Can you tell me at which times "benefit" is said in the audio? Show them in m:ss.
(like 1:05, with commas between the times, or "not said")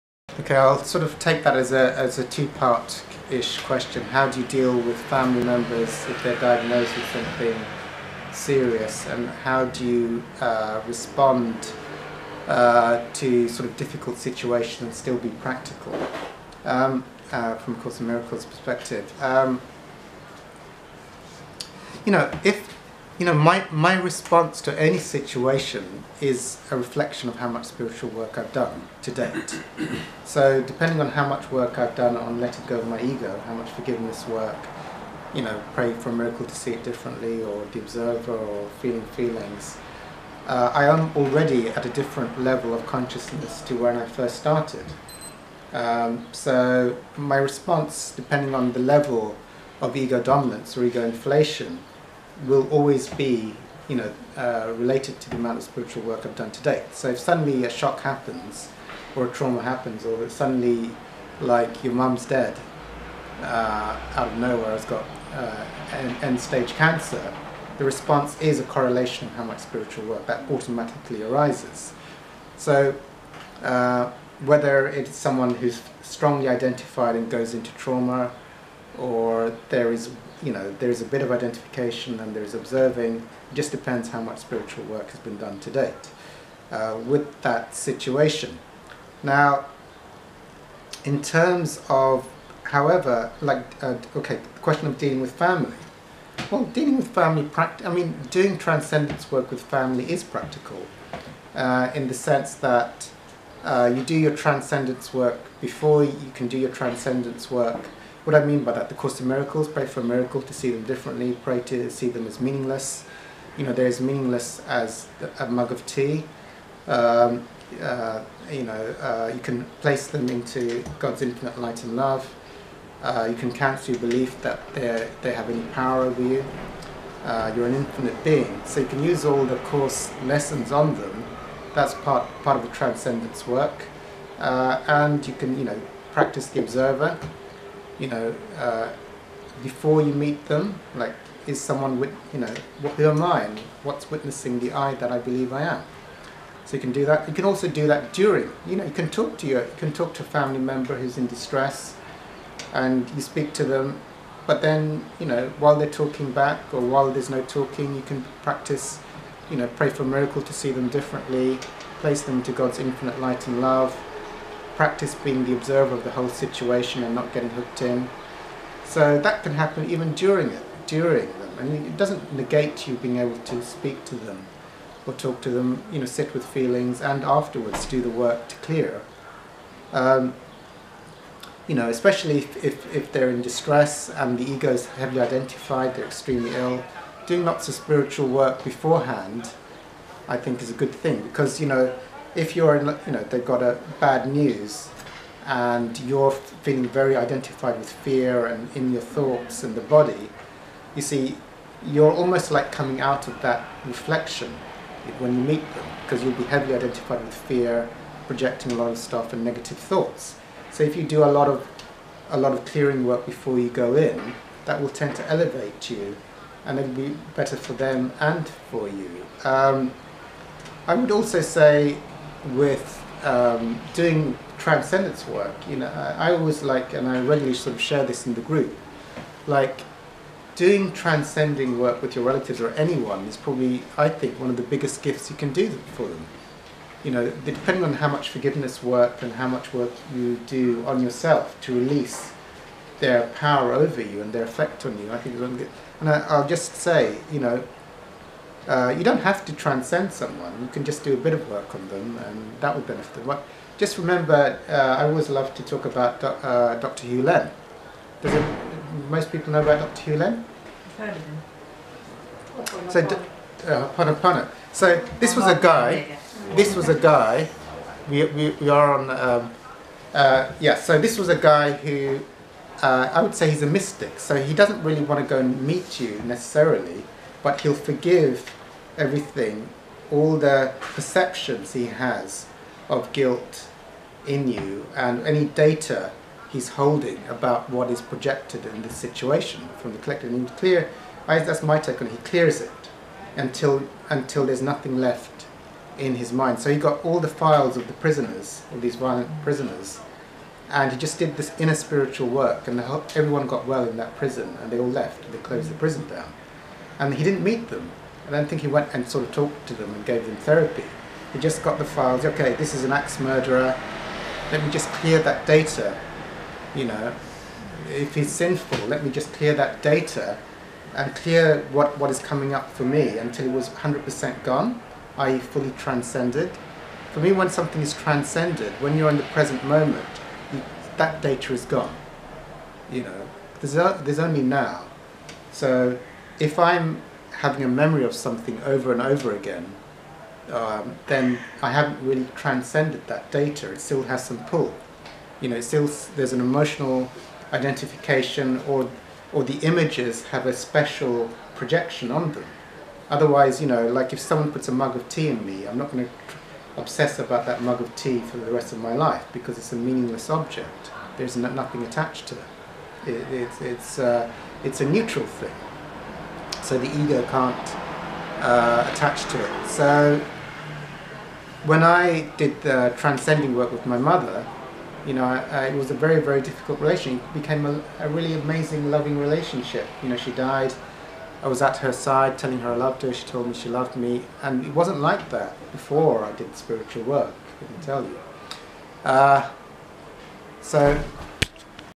4:12.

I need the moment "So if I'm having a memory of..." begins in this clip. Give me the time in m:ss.
5:35.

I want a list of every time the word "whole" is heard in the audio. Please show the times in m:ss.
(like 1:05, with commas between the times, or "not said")
2:46, 5:02.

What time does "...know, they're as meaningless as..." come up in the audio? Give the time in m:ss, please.
1:53.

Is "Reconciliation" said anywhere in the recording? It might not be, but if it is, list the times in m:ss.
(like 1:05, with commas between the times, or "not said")
not said.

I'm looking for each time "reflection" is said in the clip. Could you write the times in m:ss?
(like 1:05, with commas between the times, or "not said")
0:26, 3:23.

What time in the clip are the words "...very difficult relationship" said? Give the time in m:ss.
6:16.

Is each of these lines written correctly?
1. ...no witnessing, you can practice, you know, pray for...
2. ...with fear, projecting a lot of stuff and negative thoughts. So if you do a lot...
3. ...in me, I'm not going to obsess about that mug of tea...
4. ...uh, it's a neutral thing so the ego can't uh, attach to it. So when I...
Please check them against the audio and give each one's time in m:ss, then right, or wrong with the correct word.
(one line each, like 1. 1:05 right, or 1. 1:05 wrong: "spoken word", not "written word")
1. 2:37 wrong: "talking", not "witnessing"
2. 3:27 right
3. 5:55 right
4. 6:03 right.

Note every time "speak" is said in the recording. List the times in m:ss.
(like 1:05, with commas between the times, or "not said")
2:33, 2:53.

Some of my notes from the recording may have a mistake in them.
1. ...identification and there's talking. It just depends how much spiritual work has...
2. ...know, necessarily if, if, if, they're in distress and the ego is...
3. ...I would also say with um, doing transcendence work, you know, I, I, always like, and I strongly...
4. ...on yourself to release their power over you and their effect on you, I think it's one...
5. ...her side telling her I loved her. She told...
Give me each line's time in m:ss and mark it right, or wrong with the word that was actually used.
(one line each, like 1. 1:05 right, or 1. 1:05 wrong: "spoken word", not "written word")
1. 1:21 wrong: "observing", not "talking"
2. 3:01 wrong: "especially", not "necessarily"
3. 3:40 wrong: "regularly", not "strongly"
4. 4:00 right
5. 6:21 right.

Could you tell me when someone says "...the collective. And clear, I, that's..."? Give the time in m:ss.
4:49.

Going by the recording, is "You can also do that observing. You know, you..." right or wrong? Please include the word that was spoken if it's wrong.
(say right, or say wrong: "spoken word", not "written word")
wrong: "during", not "observing".